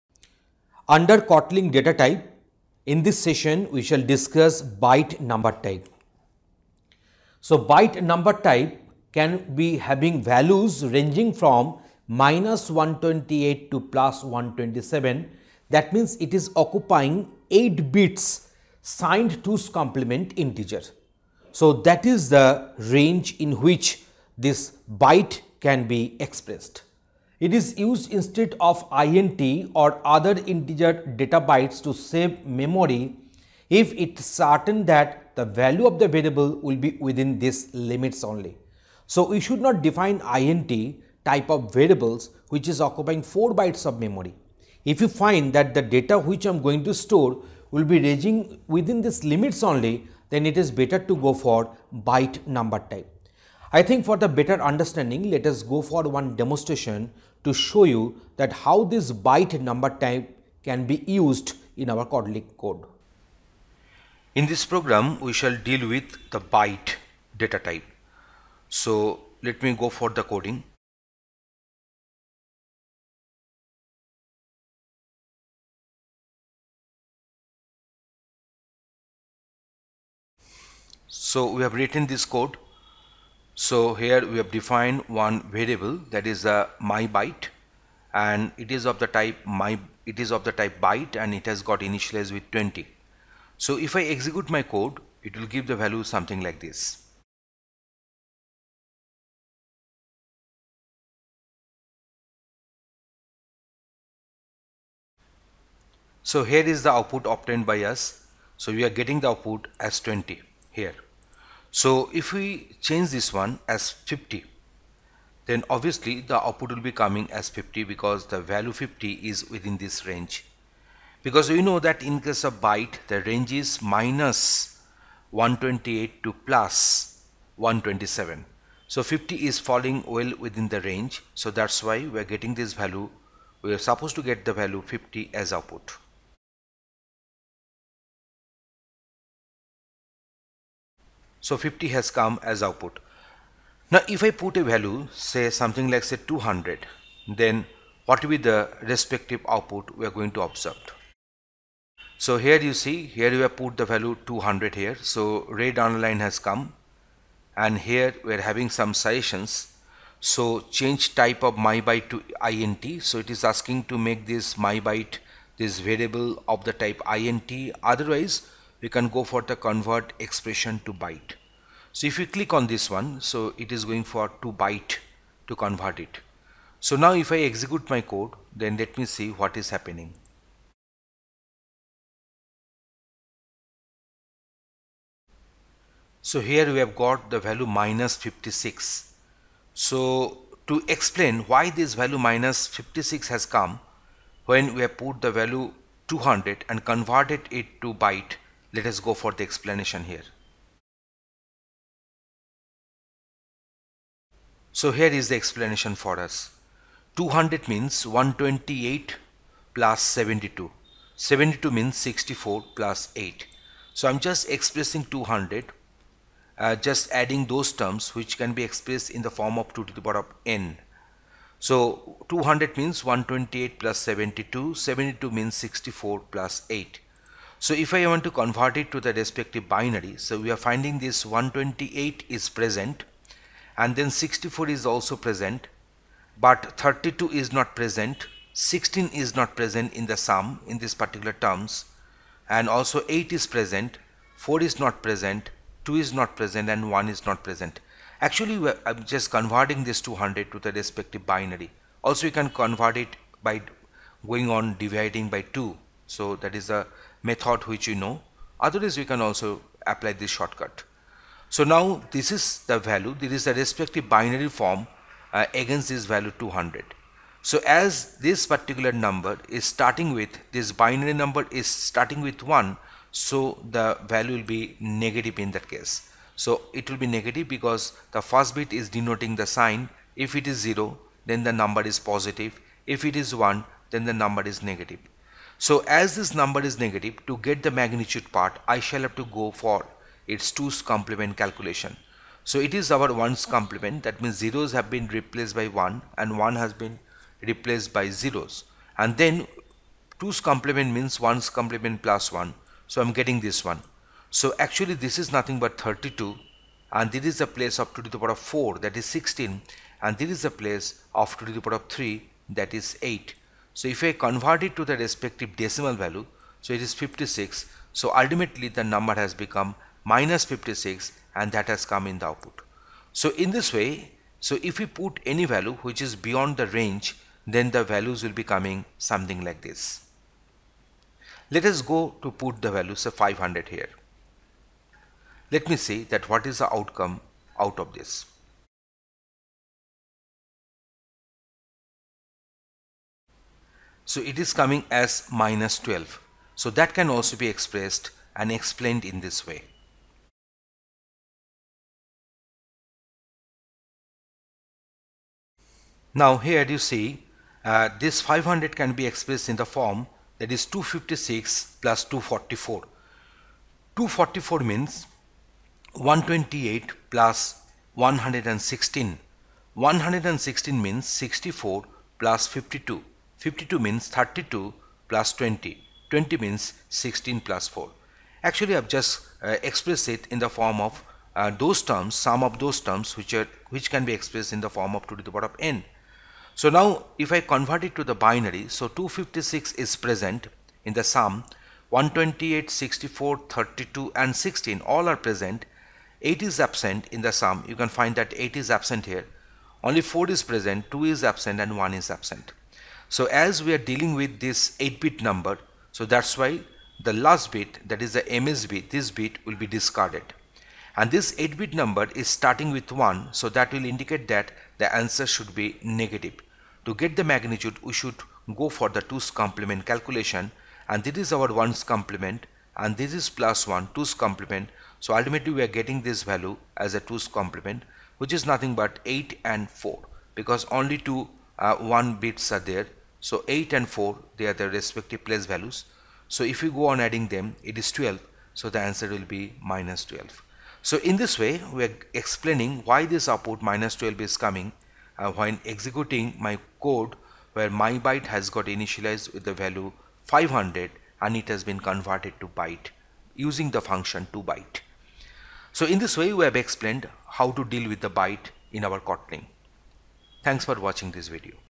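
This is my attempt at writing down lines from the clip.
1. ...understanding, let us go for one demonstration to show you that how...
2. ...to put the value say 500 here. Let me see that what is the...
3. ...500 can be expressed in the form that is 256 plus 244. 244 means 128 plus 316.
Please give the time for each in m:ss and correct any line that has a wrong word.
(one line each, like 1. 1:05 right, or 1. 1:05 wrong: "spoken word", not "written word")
1. 0:54 right
2. 5:32 right
3. 5:58 wrong: "116", not "316".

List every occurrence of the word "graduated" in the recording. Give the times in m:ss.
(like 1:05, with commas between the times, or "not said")
not said.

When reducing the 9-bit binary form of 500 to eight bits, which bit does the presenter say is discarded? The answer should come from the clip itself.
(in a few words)
MSB.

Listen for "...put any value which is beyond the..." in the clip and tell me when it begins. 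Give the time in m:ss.
5:24.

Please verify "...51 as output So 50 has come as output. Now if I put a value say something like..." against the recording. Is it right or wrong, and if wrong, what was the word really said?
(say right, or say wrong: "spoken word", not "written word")
wrong: "50", not "51".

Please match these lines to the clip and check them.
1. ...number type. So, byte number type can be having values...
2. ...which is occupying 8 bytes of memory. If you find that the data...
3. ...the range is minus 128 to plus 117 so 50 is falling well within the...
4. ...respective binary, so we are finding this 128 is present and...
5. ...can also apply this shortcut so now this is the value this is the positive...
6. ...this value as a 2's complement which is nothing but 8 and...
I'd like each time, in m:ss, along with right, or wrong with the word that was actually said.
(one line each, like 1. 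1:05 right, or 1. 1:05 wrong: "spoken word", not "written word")
1. 0:05 right
2. 0:42 wrong: "4", not "8"
3. 2:03 wrong: "127", not "117"
4. 3:49 right
5. 4:19 wrong: "respective", not "positive"
6. 7:06 right.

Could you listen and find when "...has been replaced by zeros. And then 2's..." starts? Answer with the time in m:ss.
4:56.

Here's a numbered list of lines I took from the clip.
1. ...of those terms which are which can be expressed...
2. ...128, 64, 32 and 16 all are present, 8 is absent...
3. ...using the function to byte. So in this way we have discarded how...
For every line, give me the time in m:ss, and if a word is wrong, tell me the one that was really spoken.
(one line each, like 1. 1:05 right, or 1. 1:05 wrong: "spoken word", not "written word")
1. 6:22 right
2. 6:31 right
3. 7:33 wrong: "explained", not "discarded".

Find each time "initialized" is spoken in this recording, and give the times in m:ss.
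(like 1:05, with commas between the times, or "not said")
1:31, 7:28.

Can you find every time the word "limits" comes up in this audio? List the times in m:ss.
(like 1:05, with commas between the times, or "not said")
0:37, 0:49.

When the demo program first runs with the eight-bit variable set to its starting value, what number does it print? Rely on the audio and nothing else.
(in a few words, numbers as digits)
20.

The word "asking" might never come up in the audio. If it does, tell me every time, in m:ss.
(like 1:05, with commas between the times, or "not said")
2:43.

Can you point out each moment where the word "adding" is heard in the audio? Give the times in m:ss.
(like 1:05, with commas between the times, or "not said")
3:37, 7:16.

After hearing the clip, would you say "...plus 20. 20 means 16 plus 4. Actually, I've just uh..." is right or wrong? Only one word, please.
right.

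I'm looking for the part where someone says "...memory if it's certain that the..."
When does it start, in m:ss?
0:32.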